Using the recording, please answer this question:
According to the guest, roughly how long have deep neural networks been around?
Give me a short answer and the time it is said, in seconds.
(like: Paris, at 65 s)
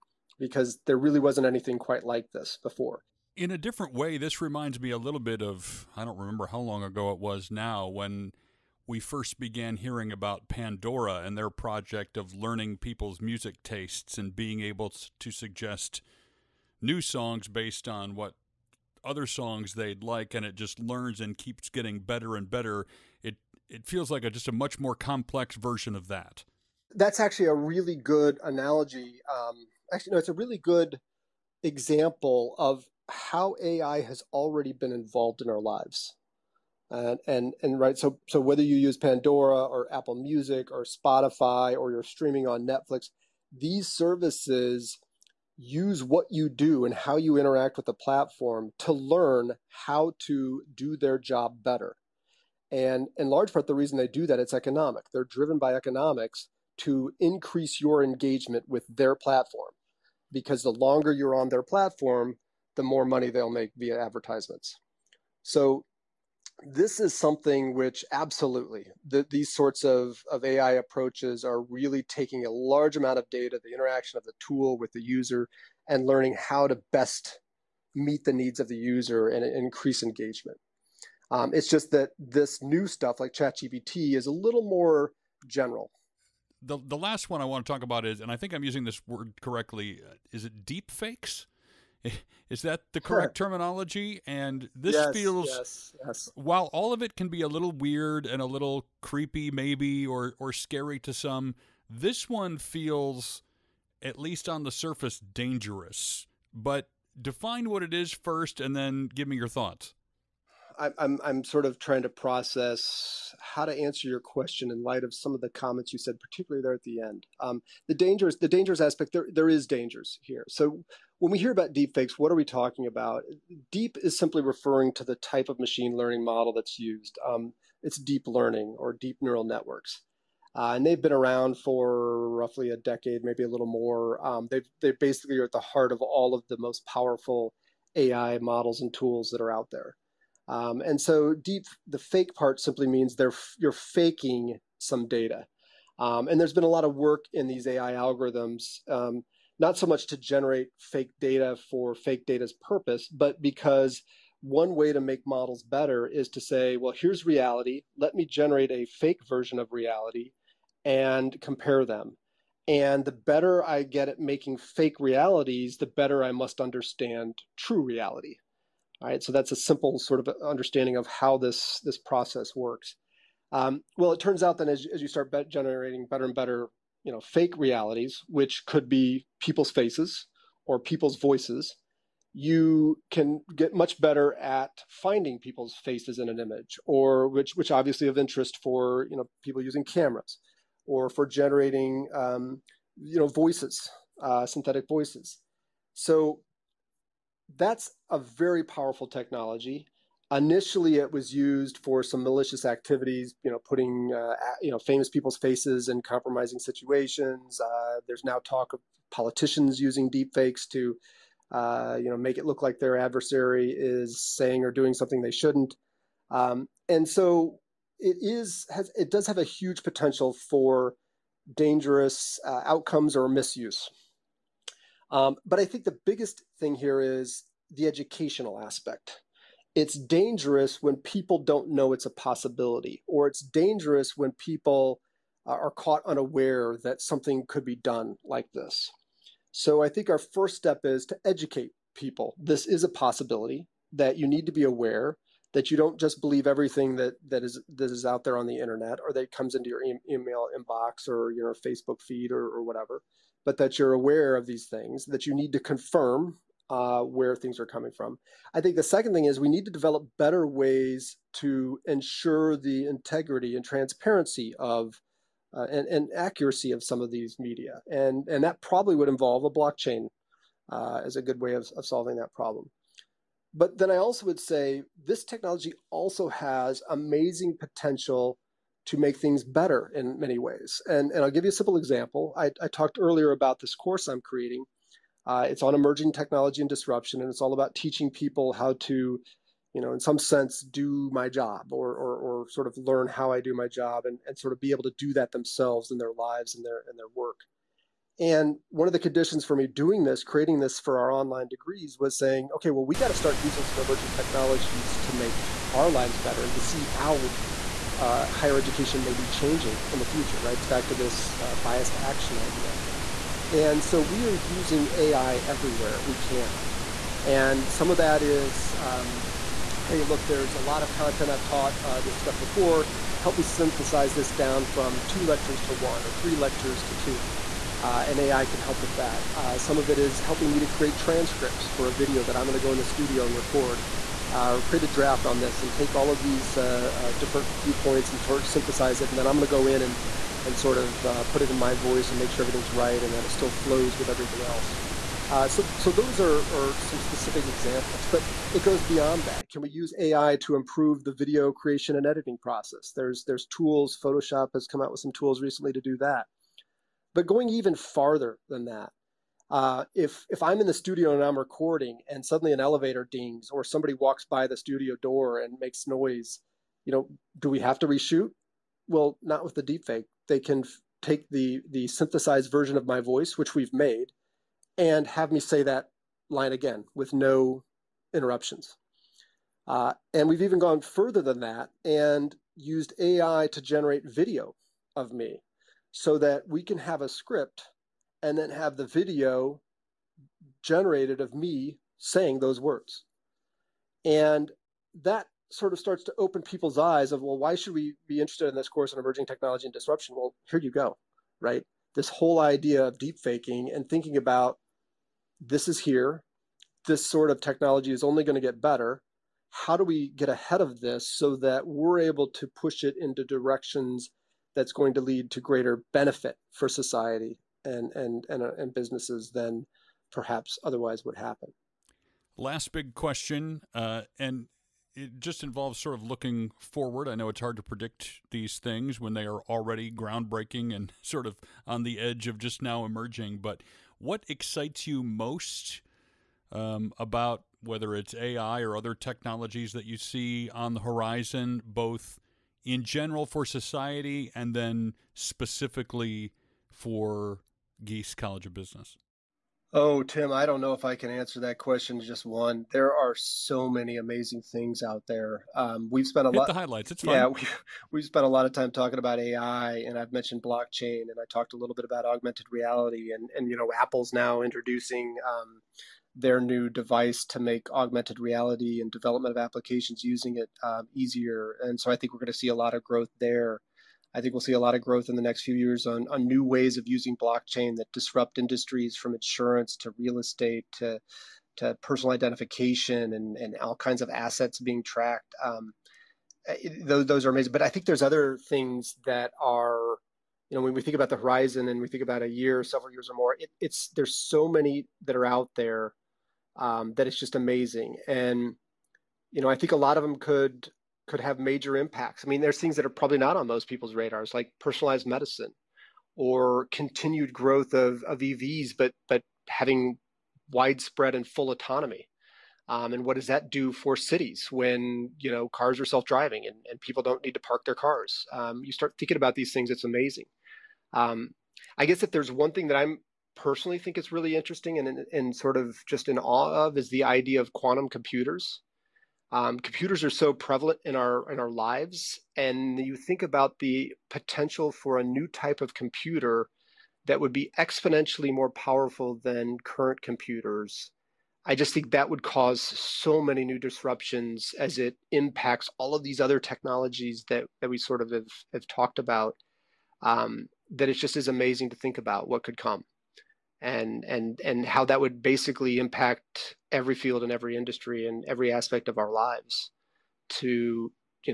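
A decade, at 132 s.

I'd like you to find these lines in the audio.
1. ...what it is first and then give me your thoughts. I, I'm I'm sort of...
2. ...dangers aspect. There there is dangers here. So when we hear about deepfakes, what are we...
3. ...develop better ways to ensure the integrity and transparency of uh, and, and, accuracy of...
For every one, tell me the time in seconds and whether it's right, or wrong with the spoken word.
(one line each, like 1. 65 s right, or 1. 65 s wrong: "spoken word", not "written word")
1. 107 s right
2. 118 s right
3. 259 s right.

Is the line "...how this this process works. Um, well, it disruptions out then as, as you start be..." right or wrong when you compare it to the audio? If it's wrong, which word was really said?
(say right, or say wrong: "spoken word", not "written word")
wrong: "turns", not "disruptions".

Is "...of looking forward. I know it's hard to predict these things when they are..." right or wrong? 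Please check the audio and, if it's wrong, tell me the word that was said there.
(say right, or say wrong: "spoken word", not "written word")
right.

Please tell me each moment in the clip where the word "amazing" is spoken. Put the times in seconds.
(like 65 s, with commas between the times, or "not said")
276 s, 453 s, 487 s, 497 s, 519 s, 551 s.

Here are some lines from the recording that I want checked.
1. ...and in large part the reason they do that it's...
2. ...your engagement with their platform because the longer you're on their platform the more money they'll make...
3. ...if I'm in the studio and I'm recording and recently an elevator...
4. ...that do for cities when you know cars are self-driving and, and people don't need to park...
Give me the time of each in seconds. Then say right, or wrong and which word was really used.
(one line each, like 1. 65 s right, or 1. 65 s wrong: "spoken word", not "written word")
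1. 52 s right
2. 57 s right
3. 360 s wrong: "suddenly", not "recently"
4. 513 s right.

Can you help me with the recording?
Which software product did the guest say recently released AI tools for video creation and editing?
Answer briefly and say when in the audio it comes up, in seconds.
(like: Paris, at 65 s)
Photoshop, at 354 s.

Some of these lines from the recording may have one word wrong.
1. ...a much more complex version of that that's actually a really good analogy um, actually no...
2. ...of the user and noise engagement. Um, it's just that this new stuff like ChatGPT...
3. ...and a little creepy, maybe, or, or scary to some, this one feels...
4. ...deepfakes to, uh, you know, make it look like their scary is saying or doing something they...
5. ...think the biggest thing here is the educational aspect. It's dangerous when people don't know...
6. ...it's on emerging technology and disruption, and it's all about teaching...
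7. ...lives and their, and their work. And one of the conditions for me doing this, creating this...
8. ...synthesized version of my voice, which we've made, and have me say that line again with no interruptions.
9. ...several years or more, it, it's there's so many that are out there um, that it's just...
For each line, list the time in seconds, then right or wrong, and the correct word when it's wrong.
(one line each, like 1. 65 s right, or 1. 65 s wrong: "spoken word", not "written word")
1. 24 s right
2. 78 s wrong: "increase", not "noise"
3. 98 s right
4. 210 s wrong: "adversary", not "scary"
5. 225 s right
6. 285 s right
7. 296 s right
8. 371 s right
9. 492 s right.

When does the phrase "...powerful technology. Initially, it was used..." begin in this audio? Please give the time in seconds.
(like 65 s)
198 s.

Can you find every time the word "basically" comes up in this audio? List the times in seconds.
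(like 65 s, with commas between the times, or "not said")
134 s, 555 s.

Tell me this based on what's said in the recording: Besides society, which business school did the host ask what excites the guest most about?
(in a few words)
Gies College of Business.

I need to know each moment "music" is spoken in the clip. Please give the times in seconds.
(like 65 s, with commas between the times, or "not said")
13 s, 40 s.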